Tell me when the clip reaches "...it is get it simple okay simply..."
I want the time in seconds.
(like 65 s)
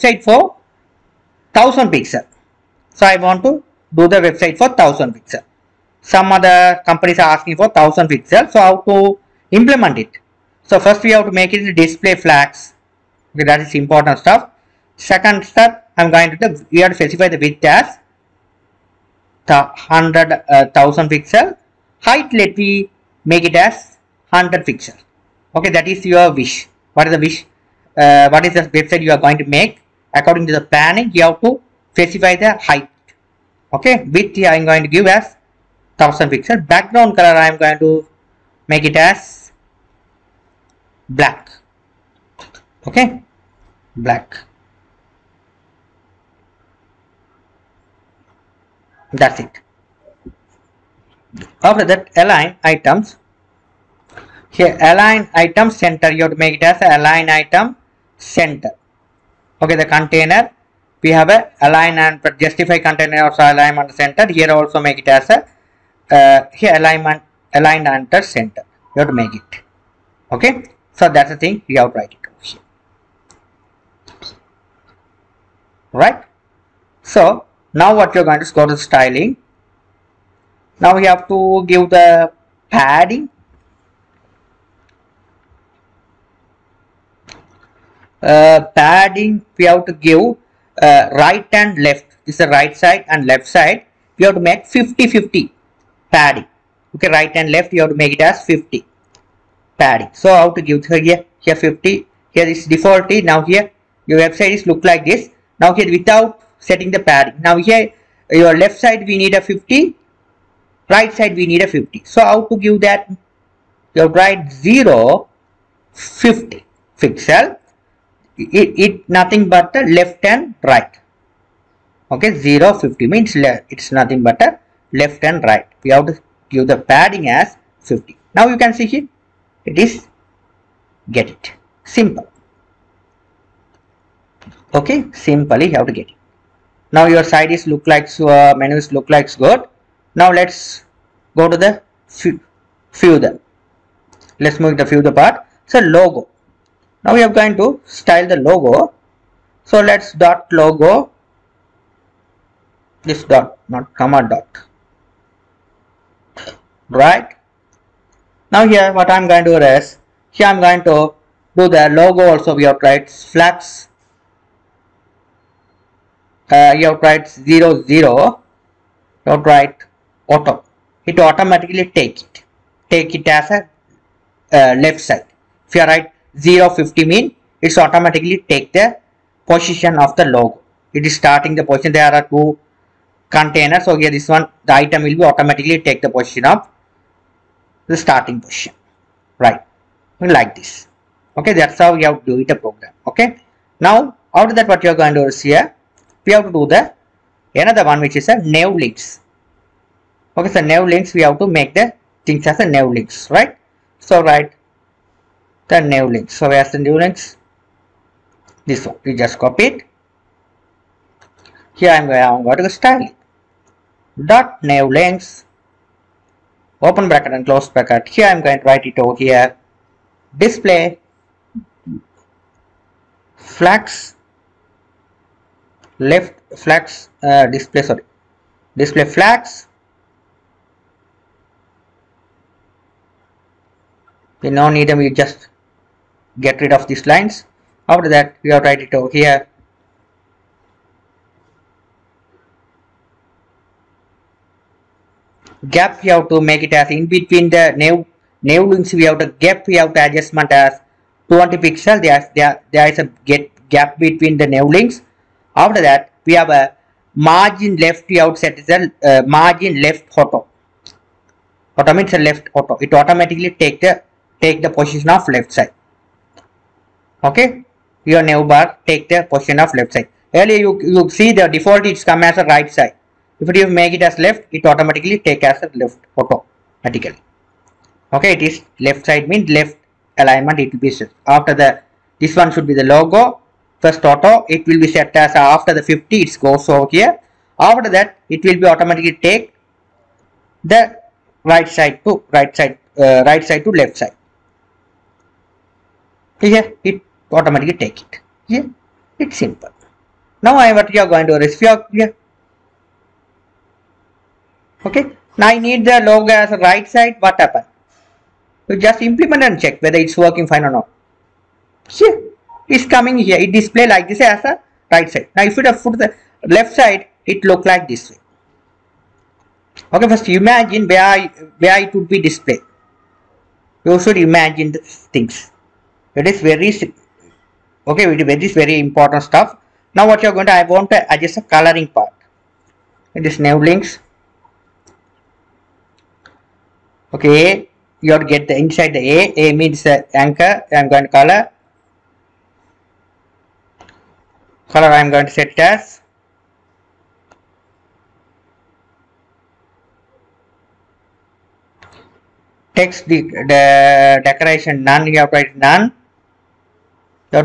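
129 s.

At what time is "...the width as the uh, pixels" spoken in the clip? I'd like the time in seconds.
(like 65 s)
17 s.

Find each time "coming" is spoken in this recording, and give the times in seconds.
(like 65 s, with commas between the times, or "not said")
312 s.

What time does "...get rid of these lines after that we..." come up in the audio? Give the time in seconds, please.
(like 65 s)
236 s.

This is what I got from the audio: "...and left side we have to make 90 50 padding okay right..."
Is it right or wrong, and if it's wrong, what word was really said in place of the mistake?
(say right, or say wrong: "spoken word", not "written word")
wrong: "50", not "90".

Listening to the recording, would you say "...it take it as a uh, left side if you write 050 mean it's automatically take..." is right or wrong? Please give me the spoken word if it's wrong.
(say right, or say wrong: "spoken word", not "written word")
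right.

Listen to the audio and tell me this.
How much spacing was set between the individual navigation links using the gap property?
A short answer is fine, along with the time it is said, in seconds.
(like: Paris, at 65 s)
20 pixels, at 251 s.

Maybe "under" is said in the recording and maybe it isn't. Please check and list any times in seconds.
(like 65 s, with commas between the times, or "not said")
67 s.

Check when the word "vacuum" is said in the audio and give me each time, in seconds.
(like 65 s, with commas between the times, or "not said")
not said.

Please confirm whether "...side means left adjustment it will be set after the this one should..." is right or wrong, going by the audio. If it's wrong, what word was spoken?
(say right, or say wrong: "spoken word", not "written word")
wrong: "alignment", not "adjustment".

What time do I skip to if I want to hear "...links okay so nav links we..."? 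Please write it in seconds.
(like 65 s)
198 s.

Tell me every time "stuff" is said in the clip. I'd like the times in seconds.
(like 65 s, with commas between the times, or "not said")
14 s, 329 s.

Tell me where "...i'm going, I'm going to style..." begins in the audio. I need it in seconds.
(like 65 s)
211 s.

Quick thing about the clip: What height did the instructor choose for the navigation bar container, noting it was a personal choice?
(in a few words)
100 pixels.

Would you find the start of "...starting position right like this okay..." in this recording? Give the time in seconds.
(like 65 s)
188 s.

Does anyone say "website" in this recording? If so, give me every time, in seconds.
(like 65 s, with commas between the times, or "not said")
4 s, 28 s, 104 s.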